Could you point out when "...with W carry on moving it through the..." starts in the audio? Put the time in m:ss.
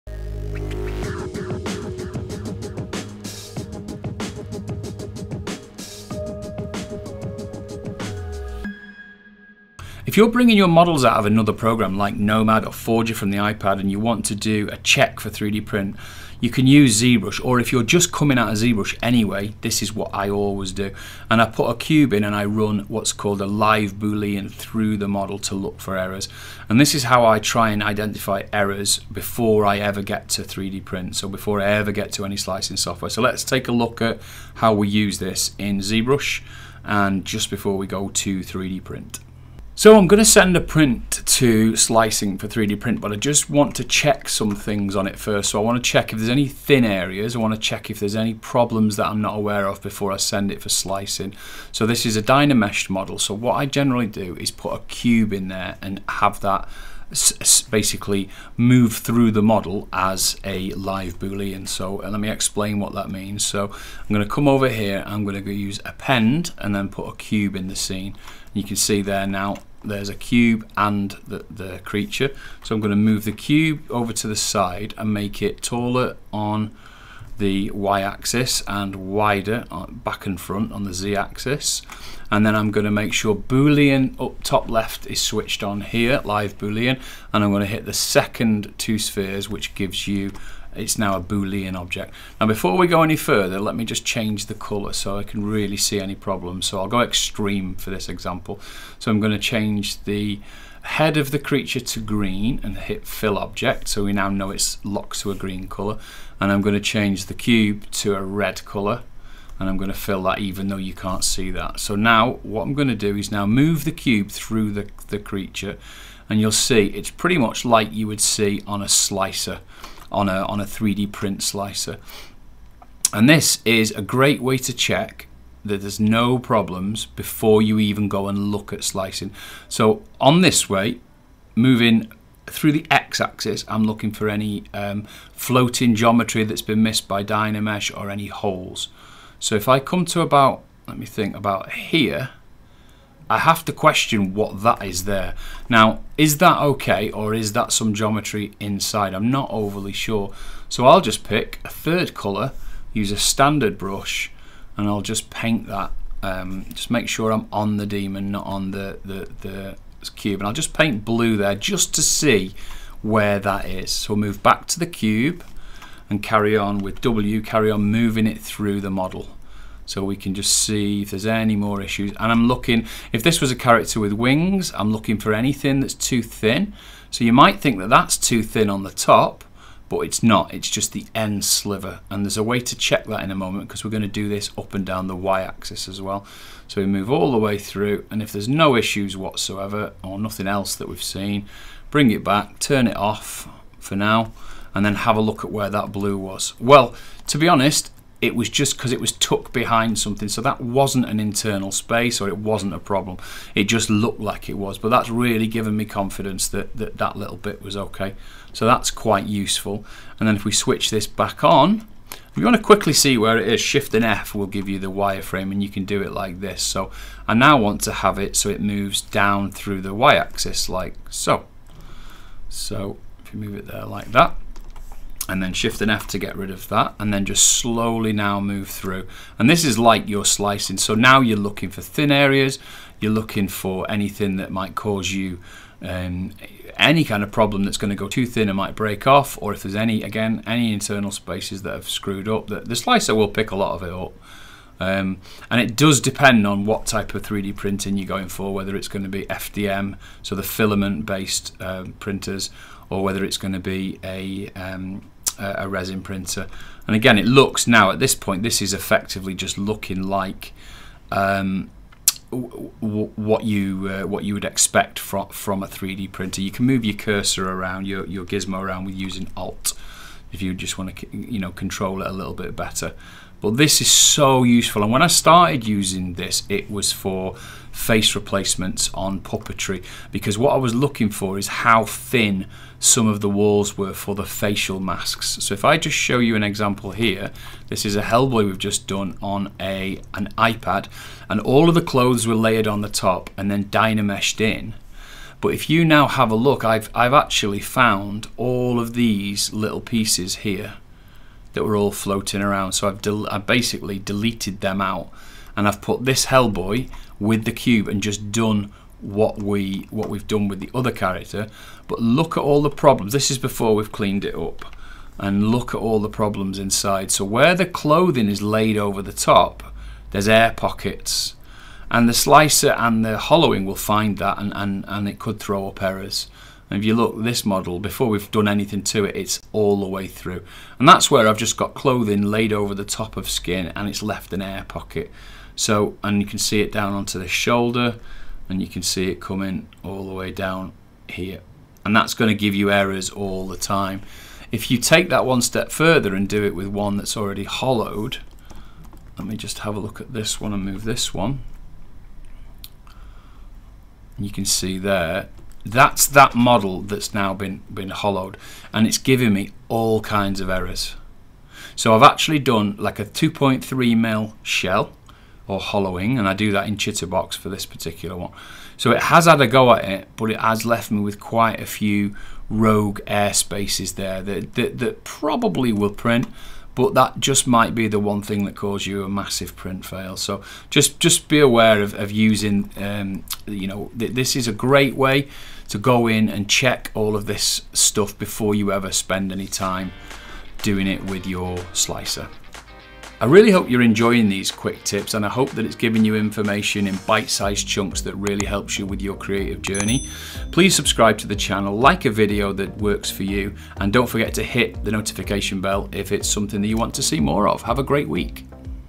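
2:46.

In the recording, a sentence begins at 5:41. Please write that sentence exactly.
And that's going to give you errors all the time.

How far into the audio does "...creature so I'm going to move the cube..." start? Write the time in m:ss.
1:11.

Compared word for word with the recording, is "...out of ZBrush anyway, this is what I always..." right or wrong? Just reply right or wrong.
right.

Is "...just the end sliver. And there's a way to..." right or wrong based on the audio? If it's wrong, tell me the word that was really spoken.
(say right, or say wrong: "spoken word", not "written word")
right.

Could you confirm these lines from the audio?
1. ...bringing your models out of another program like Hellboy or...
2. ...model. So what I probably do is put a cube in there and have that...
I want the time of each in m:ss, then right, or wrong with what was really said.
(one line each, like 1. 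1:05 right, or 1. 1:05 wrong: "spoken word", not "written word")
1. 0:10 wrong: "Nomad", not "Hellboy"
2. 0:52 wrong: "generally", not "probably".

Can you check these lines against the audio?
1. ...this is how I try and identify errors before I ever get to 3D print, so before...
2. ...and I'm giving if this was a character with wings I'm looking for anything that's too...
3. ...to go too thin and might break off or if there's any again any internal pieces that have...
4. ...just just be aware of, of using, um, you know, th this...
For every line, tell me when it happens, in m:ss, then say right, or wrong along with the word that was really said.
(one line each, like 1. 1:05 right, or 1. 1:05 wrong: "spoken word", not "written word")
1. 0:26 right
2. 2:52 wrong: "looking", not "giving"
3. 3:57 wrong: "spaces", not "pieces"
4. 6:20 right.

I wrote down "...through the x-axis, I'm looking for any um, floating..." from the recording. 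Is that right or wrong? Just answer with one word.
right.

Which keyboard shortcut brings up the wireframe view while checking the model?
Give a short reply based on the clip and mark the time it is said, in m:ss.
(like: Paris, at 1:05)
Shift and F, at 3:33.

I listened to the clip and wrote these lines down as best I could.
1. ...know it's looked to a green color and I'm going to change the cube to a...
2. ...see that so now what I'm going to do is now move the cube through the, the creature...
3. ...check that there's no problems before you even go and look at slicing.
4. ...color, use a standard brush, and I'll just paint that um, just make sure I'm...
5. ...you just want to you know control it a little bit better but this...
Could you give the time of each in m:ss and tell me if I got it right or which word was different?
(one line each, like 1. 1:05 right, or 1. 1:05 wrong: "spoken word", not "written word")
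1. 1:44 wrong: "locked", not "looked"
2. 1:51 right
3. 2:04 right
4. 2:32 right
5. 4:30 right.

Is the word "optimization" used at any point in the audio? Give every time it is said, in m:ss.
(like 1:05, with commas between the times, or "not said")
not said.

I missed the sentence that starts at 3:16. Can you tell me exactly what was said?
Well, to be honest, it was just because it was tucked behind something.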